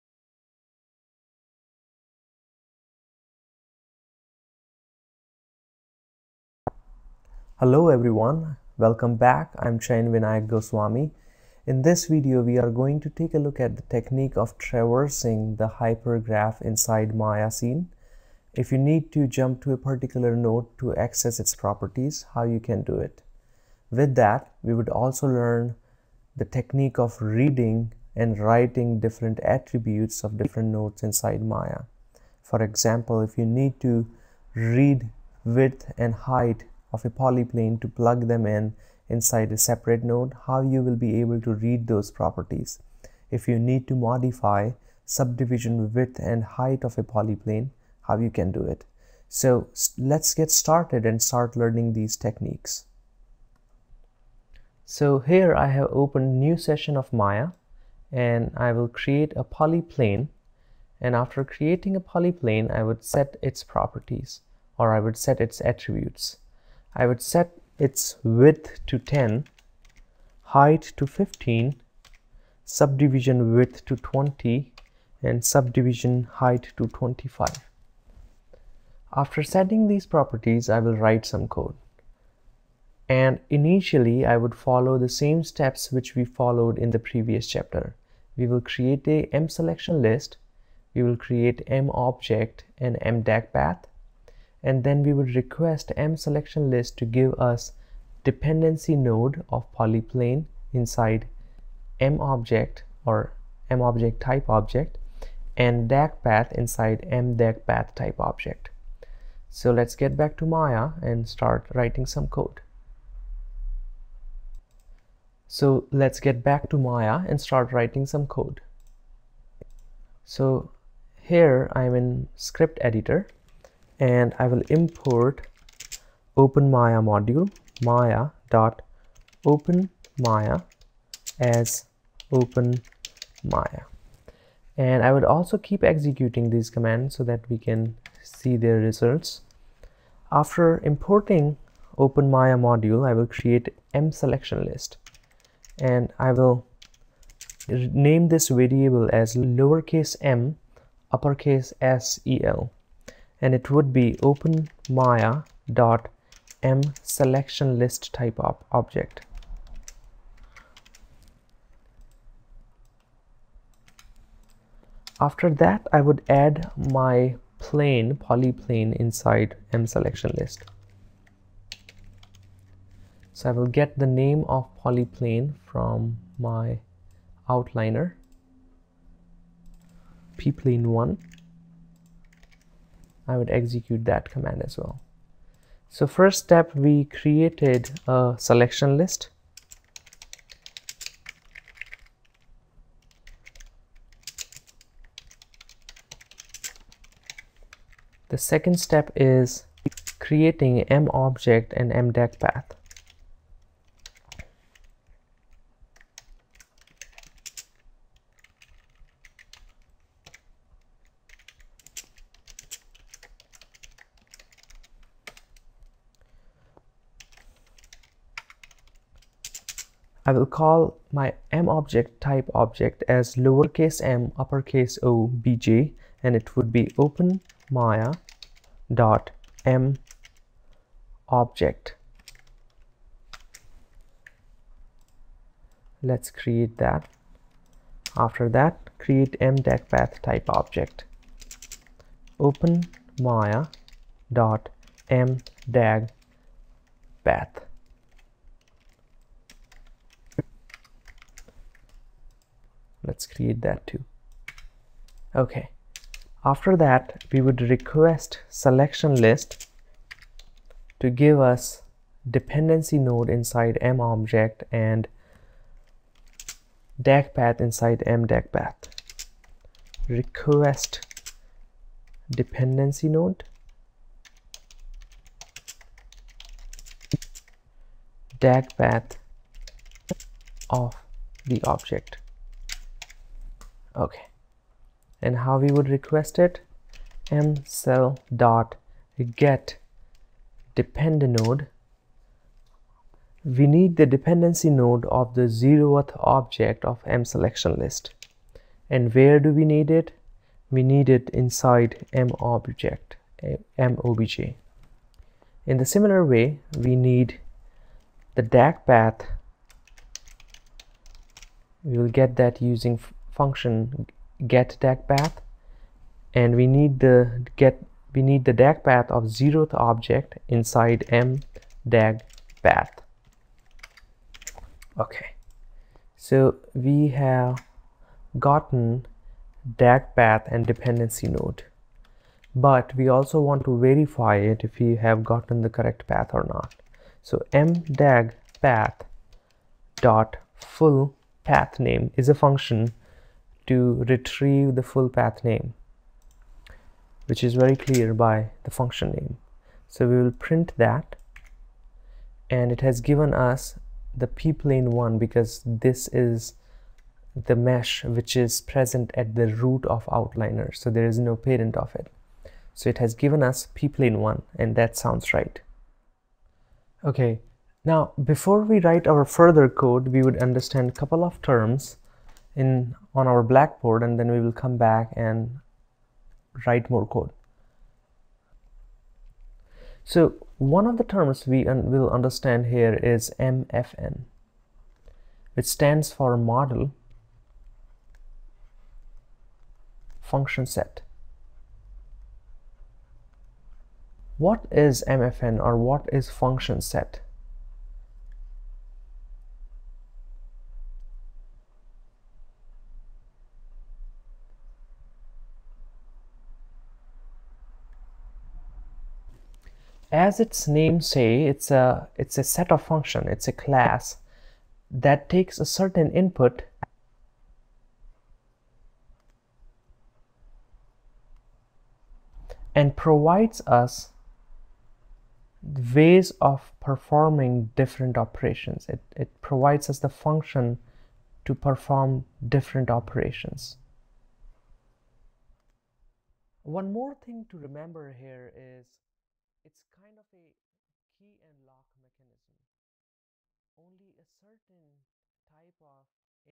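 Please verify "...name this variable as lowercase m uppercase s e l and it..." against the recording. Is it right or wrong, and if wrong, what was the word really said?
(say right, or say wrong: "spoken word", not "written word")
right.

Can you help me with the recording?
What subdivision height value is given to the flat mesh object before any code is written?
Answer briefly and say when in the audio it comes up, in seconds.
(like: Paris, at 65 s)
25, at 75 s.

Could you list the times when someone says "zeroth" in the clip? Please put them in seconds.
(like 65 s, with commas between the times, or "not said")
295 s, 319 s.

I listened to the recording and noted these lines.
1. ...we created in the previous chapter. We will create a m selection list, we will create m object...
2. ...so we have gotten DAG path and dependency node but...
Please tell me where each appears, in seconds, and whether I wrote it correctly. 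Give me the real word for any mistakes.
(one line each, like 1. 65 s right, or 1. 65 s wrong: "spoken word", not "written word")
1. 86 s wrong: "followed", not "created"
2. 326 s right.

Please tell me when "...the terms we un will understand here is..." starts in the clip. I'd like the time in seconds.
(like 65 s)
380 s.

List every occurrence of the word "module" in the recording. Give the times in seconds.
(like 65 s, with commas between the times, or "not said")
127 s, 142 s.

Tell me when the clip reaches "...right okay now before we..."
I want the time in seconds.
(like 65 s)
365 s.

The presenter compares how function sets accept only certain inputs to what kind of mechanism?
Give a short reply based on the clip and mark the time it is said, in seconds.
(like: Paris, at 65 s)
key and lock, at 441 s.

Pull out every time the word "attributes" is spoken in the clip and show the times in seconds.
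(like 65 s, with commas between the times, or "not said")
29 s, 65 s.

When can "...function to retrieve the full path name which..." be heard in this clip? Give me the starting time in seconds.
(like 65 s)
342 s.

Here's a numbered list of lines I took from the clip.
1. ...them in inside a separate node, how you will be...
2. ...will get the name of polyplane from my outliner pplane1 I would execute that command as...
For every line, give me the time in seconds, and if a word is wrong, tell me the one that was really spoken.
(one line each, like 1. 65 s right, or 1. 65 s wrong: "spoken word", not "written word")
1. 38 s right
2. 173 s right.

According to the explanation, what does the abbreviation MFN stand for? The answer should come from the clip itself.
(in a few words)
model function set.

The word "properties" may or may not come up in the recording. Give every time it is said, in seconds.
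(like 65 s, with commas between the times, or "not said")
21 s, 42 s, 63 s, 80 s.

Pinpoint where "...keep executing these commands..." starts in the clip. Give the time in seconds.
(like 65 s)
135 s.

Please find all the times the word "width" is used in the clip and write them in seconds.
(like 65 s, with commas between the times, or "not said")
35 s, 45 s, 68 s, 73 s.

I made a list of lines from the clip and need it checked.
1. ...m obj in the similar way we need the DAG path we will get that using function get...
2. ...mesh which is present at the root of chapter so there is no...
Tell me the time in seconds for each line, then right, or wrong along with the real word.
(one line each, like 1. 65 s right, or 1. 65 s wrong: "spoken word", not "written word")
1. 303 s right
2. 357 s wrong: "outliner", not "chapter".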